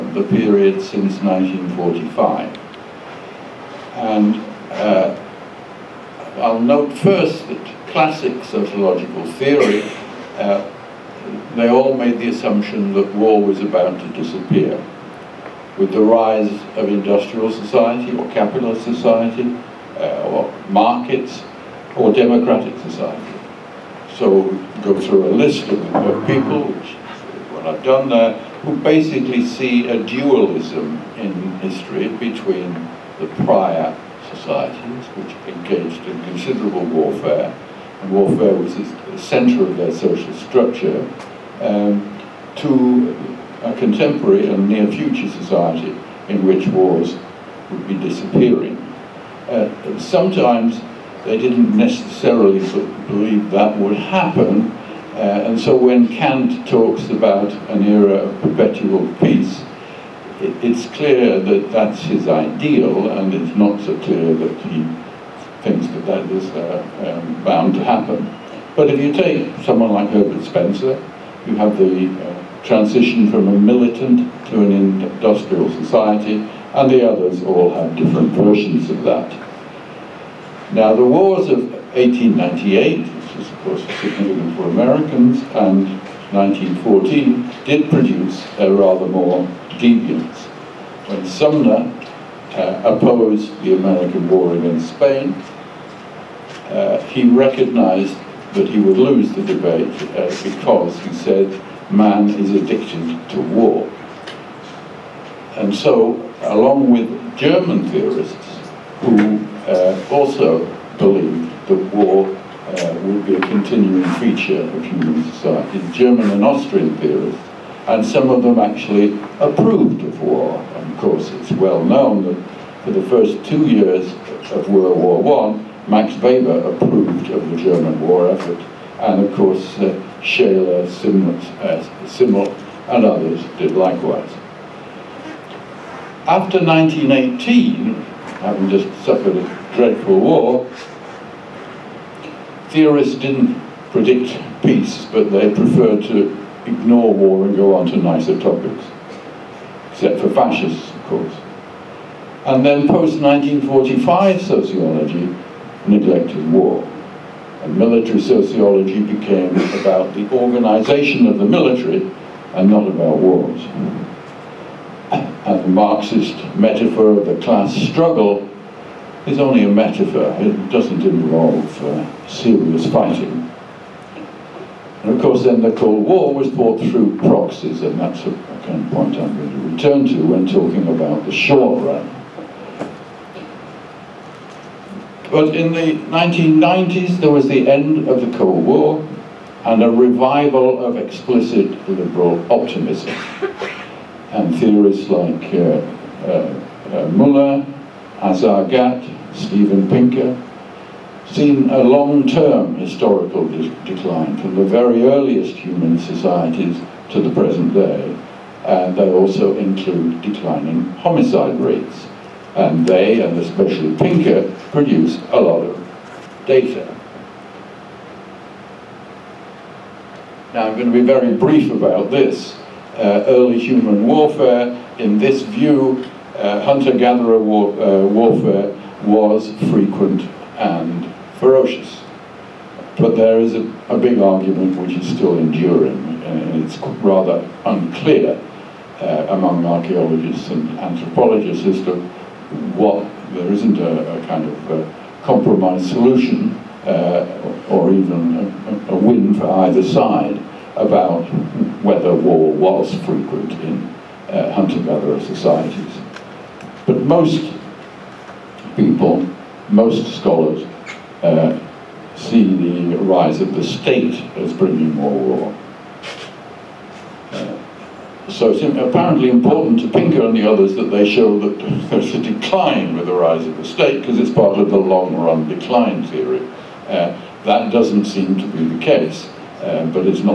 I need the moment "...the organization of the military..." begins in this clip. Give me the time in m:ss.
2:40.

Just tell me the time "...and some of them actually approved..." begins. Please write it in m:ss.
1:57.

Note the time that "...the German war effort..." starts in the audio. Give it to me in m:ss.
2:07.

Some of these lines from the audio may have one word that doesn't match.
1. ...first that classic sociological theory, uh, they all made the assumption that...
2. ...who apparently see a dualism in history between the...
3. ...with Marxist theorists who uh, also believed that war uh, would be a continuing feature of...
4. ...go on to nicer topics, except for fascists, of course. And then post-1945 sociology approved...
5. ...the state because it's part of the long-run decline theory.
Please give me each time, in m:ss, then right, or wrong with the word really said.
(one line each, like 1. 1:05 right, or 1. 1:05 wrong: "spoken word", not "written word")
1. 0:06 right
2. 0:28 wrong: "basically", not "apparently"
3. 1:46 wrong: "German", not "Marxist"
4. 2:27 wrong: "neglected", not "approved"
5. 4:33 right.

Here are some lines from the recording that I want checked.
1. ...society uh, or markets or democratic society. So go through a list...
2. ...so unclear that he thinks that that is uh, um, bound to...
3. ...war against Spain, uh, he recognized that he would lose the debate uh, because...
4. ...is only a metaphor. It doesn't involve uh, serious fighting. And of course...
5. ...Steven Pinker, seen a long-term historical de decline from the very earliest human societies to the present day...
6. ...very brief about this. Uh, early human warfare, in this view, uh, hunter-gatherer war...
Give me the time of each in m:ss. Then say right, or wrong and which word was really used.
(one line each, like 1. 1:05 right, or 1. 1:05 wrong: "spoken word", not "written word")
1. 0:18 right
2. 1:03 wrong: "clear", not "unclear"
3. 1:34 right
4. 2:49 right
5. 3:19 right
6. 3:41 right.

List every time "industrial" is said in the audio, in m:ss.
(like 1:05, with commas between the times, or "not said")
0:16, 1:14.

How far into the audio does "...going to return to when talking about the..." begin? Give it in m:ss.
2:59.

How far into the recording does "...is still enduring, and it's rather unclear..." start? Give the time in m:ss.
3:54.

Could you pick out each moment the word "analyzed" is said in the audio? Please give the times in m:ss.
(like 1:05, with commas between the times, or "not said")
not said.